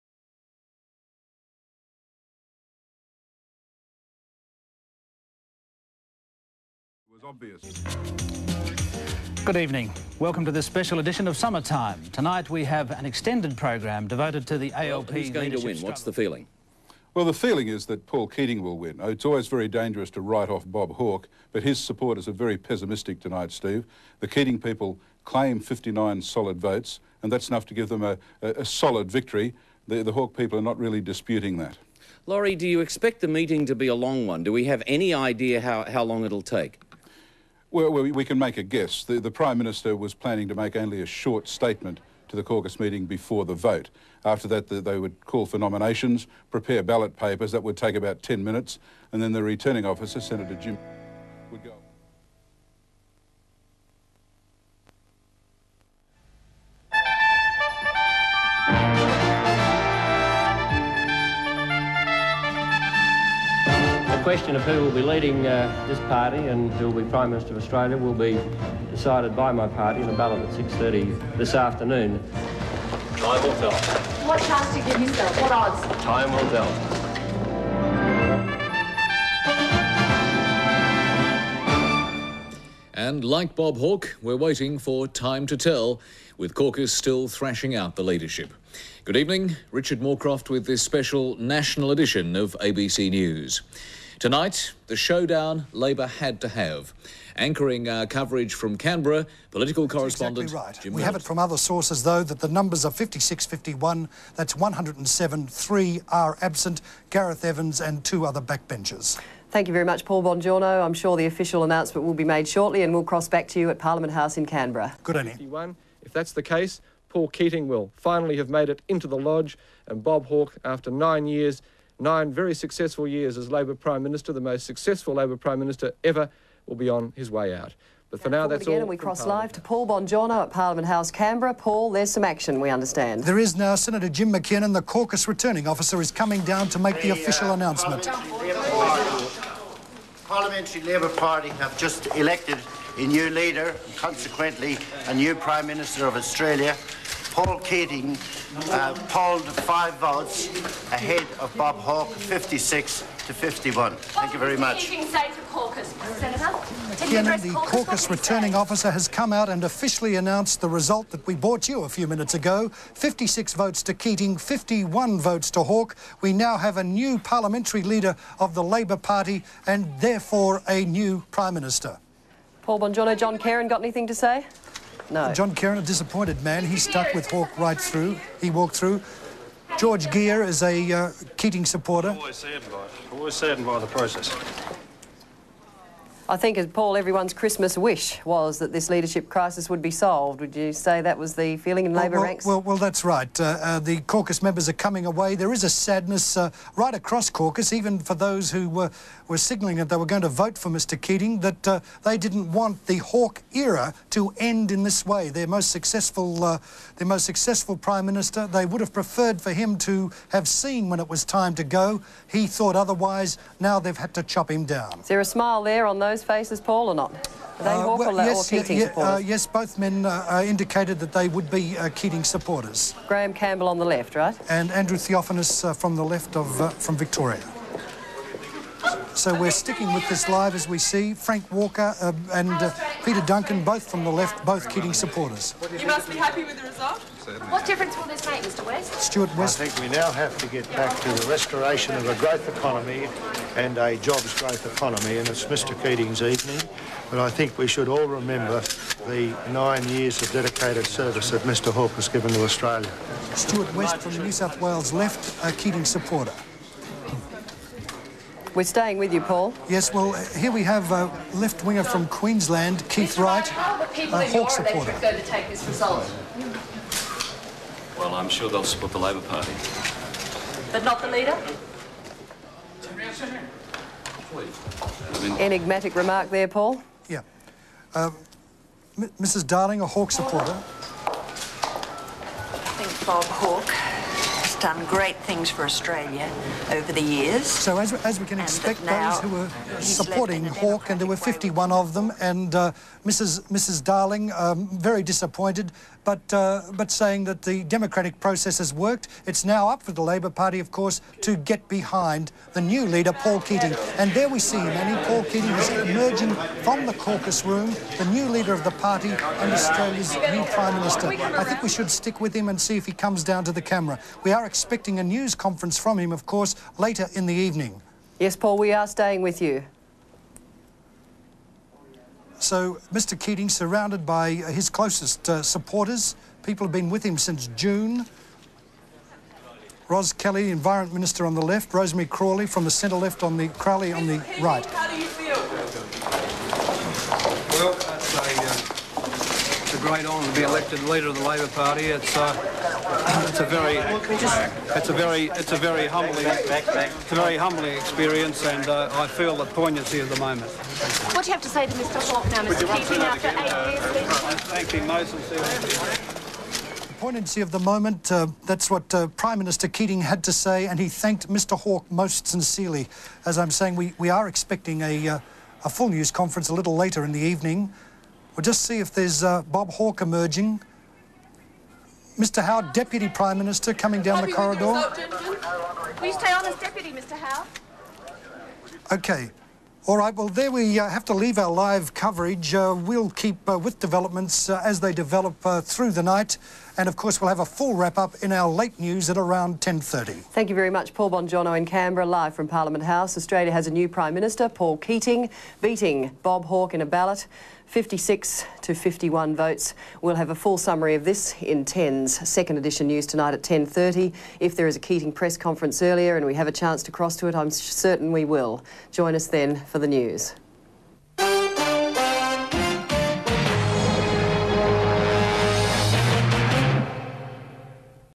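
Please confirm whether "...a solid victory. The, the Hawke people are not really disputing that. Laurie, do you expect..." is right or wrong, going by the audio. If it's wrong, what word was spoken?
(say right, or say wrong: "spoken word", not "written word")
right.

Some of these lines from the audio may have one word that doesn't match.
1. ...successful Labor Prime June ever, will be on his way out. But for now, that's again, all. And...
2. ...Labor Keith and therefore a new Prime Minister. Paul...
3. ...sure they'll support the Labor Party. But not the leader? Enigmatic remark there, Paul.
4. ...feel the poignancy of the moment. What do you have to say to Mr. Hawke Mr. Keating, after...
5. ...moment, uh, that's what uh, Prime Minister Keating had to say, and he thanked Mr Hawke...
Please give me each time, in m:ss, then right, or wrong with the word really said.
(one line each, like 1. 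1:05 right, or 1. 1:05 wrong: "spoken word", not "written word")
1. 2:04 wrong: "Minister", not "June"
2. 2:48 wrong: "Party", not "Keith"
3. 4:28 right
4. 5:49 right
5. 5:57 right.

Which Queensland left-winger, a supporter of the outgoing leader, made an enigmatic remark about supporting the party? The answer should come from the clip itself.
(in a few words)
Keith Wright.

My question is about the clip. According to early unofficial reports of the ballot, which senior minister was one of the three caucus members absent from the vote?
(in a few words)
Gareth Evans.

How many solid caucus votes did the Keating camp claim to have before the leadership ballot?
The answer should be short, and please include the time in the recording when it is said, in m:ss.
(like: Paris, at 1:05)
59, at 0:25.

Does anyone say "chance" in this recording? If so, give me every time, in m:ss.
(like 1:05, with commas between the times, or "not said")
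1:14, 6:46.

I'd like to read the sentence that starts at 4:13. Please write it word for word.
Stewart West from New South Wales left, a Keating supporter.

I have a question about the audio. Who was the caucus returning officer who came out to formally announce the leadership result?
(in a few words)
Jim McKiernan.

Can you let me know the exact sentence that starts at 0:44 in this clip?
After that, the, they would call for nominations, prepare ballot papers.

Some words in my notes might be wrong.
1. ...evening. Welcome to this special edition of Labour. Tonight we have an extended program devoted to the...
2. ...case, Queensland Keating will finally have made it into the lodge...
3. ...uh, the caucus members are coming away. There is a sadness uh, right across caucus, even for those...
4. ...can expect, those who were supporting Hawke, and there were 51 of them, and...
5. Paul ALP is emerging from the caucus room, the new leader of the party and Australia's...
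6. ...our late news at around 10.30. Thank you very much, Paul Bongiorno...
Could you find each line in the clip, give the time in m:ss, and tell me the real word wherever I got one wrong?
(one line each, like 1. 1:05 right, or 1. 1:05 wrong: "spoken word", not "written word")
1. 0:09 wrong: "Summertime", not "Labour"
2. 1:56 wrong: "Paul", not "Queensland"
3. 3:13 right
4. 4:48 right
5. 5:05 wrong: "Keating", not "ALP"
6. 6:28 right.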